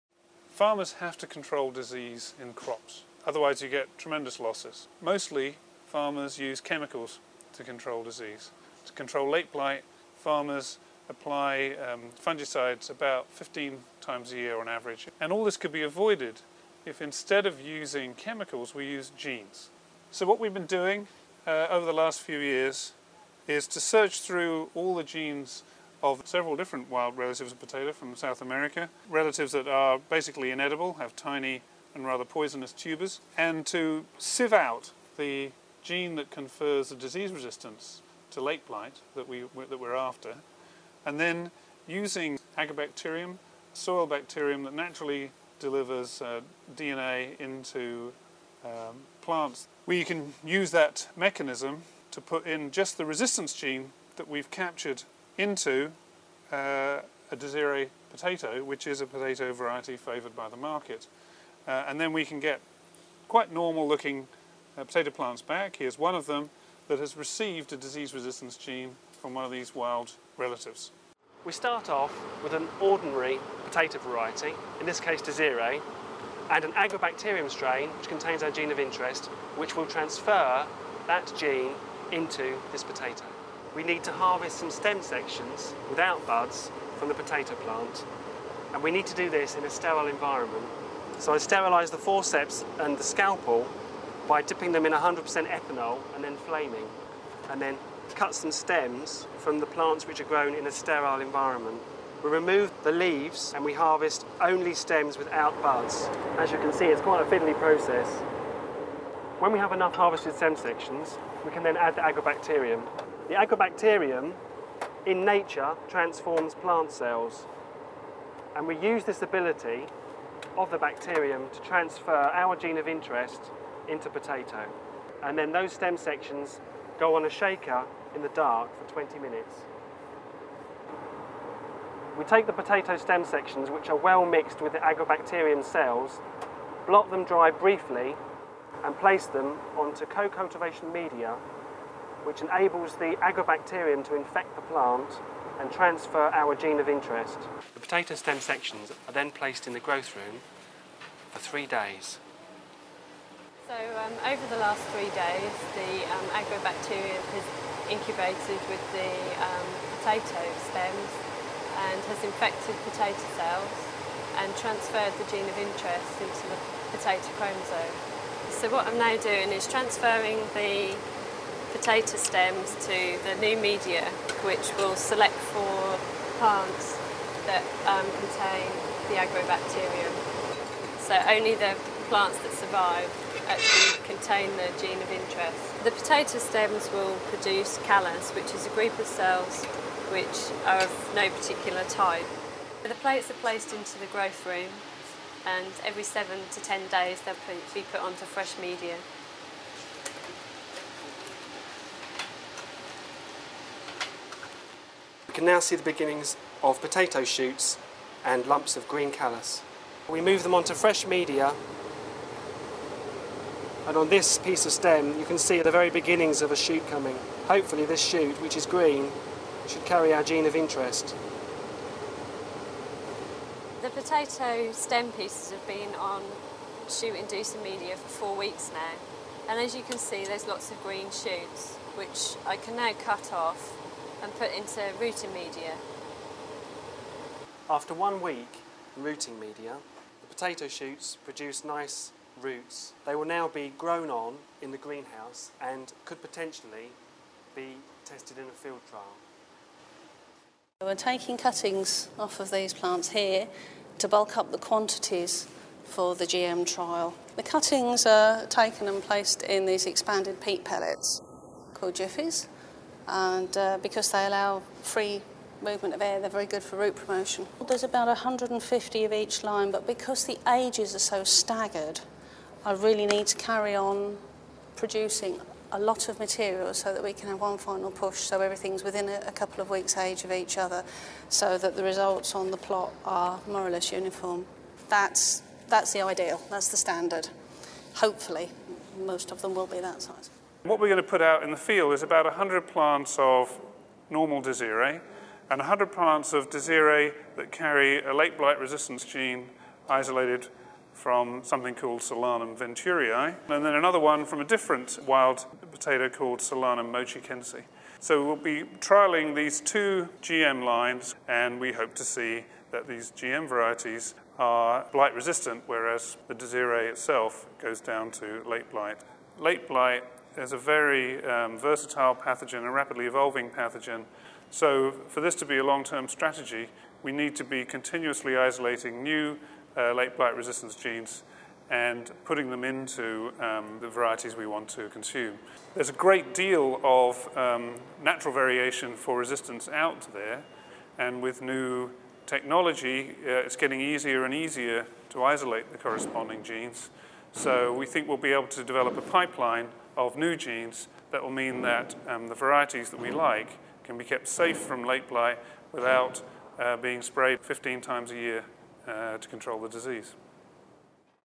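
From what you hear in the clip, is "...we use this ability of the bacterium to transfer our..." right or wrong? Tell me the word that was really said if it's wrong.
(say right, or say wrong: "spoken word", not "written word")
right.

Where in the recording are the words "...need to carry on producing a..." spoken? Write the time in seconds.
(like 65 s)
273 s.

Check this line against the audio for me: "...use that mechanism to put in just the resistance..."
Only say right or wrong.
right.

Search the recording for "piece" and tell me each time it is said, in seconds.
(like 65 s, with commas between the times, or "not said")
214 s, 225 s.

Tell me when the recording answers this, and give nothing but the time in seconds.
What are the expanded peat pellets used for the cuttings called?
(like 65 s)
261 s.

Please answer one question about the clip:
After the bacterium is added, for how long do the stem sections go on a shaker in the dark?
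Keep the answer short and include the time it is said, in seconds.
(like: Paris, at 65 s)
20 minutes, at 128 s.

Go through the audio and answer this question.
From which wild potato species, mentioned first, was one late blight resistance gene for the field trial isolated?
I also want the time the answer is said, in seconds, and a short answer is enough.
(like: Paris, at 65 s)
Solanum venturii, at 302 s.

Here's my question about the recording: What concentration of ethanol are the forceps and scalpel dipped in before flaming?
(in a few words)
100%.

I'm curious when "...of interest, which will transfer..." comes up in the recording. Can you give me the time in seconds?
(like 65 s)
78 s.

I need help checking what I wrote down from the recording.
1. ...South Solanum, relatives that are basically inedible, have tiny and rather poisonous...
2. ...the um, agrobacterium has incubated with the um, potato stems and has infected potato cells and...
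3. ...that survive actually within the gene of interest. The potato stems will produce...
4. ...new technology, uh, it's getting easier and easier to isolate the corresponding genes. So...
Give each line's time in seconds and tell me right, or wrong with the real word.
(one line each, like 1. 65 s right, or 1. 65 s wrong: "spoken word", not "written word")
1. 28 s wrong: "America", not "Solanum"
2. 155 s right
3. 182 s wrong: "contain", not "within"
4. 341 s right.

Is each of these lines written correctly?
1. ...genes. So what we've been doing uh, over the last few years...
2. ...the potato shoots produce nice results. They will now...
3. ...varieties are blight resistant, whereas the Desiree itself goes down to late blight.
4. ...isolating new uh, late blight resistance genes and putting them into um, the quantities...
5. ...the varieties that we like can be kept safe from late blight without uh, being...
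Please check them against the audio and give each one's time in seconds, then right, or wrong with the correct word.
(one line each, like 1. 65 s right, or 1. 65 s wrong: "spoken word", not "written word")
1. 19 s right
2. 240 s wrong: "roots", not "results"
3. 313 s right
4. 328 s wrong: "varieties", not "quantities"
5. 352 s right.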